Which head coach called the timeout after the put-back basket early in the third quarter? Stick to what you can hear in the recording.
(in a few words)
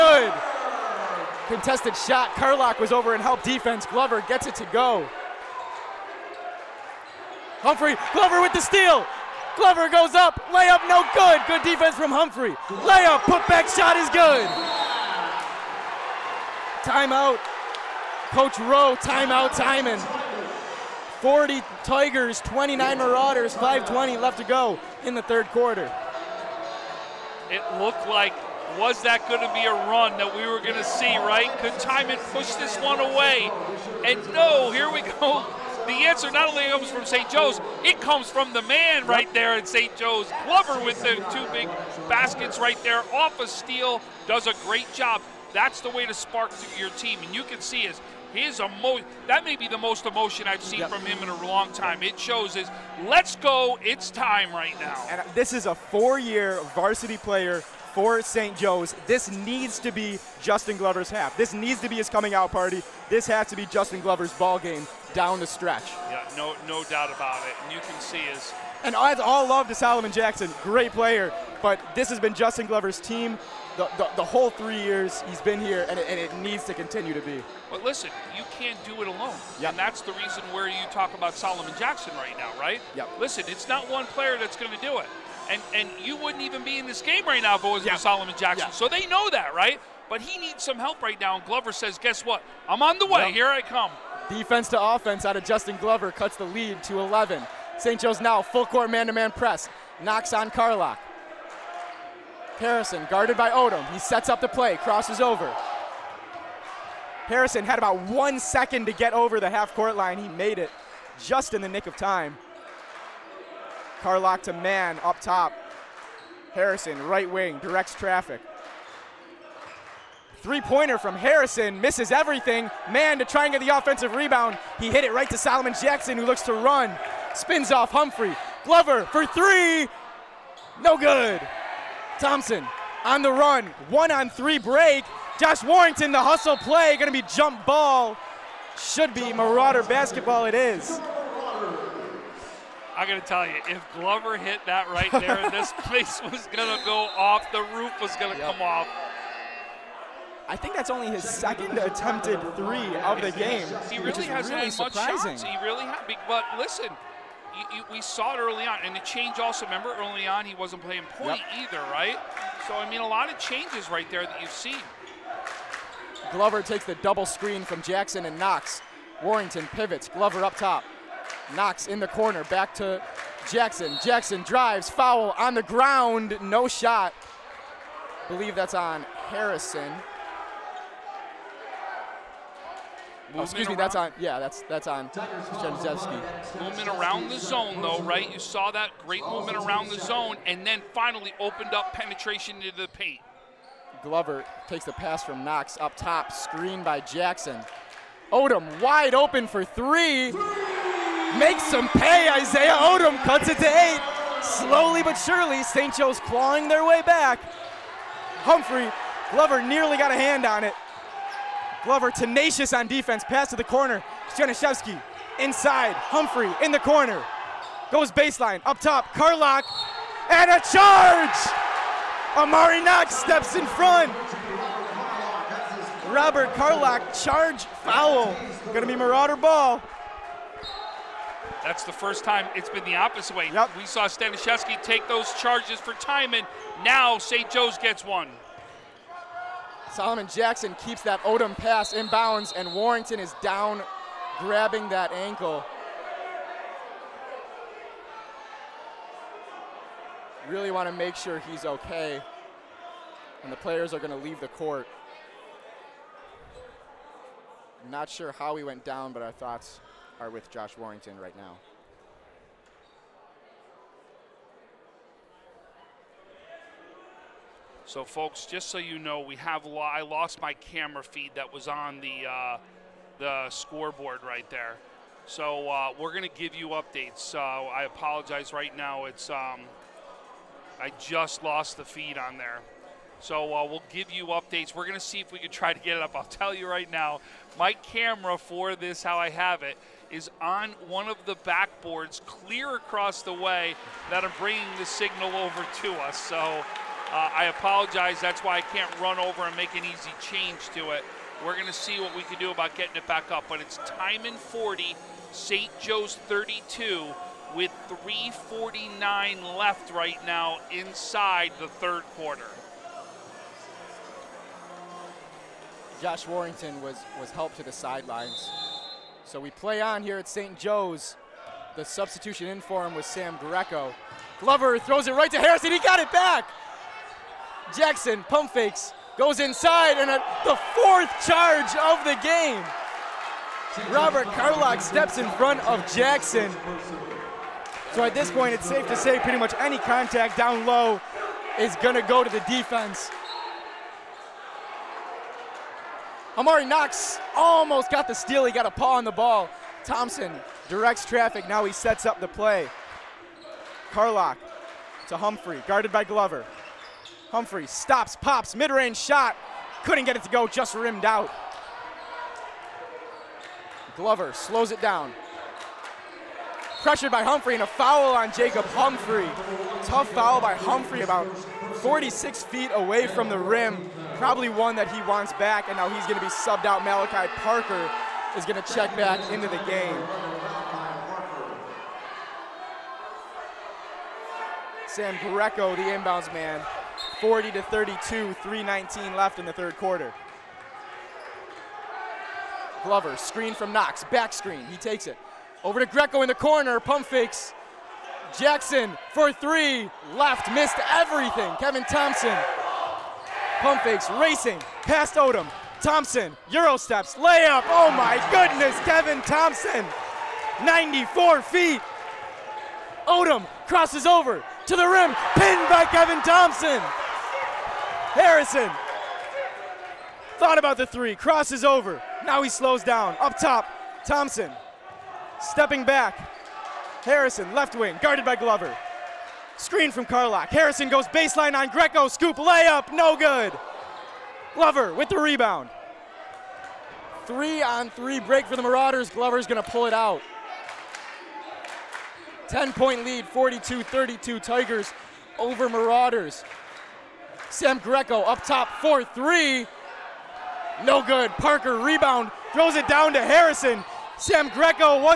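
Coach Rowe.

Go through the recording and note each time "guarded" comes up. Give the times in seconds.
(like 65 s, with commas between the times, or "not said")
103 s, 355 s, 427 s.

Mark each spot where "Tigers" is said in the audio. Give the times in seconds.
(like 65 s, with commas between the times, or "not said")
21 s, 444 s.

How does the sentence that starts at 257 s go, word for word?
I'm not sure how he went down, but our thoughts are with Josh Warrington right now.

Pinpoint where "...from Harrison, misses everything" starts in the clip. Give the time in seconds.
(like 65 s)
120 s.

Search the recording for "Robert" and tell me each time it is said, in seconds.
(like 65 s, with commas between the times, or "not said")
226 s, 333 s.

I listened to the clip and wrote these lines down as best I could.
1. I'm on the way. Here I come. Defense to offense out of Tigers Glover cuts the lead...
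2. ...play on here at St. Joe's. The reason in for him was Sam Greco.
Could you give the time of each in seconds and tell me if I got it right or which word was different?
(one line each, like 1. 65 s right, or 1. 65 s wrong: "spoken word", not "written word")
1. 92 s wrong: "Justin", not "Tigers"
2. 319 s wrong: "substitution", not "reason".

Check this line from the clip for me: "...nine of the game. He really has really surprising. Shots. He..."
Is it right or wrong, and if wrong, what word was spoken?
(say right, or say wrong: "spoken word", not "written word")
wrong: "three", not "nine".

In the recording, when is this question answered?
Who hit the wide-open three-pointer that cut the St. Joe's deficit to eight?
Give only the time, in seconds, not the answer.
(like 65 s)
202 s.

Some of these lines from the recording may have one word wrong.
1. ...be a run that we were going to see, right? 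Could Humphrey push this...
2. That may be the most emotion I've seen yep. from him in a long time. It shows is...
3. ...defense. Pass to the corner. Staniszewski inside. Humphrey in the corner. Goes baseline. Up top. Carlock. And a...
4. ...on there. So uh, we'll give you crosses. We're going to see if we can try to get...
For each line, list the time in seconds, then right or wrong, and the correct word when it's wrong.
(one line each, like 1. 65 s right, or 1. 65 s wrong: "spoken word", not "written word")
1. 29 s wrong: "Timon", not "Humphrey"
2. 49 s right
3. 212 s right
4. 282 s wrong: "updates", not "crosses".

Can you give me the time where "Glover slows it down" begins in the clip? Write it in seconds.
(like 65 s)
363 s.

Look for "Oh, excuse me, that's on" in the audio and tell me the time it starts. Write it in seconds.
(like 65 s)
183 s.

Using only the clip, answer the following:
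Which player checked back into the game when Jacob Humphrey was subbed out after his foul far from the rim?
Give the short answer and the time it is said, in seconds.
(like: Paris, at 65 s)
Malachi Parker, at 376 s.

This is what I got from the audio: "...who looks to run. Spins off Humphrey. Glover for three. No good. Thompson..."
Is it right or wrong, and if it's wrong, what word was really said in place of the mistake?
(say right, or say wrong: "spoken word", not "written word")
right.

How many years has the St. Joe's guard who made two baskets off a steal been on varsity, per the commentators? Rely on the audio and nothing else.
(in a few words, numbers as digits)
4.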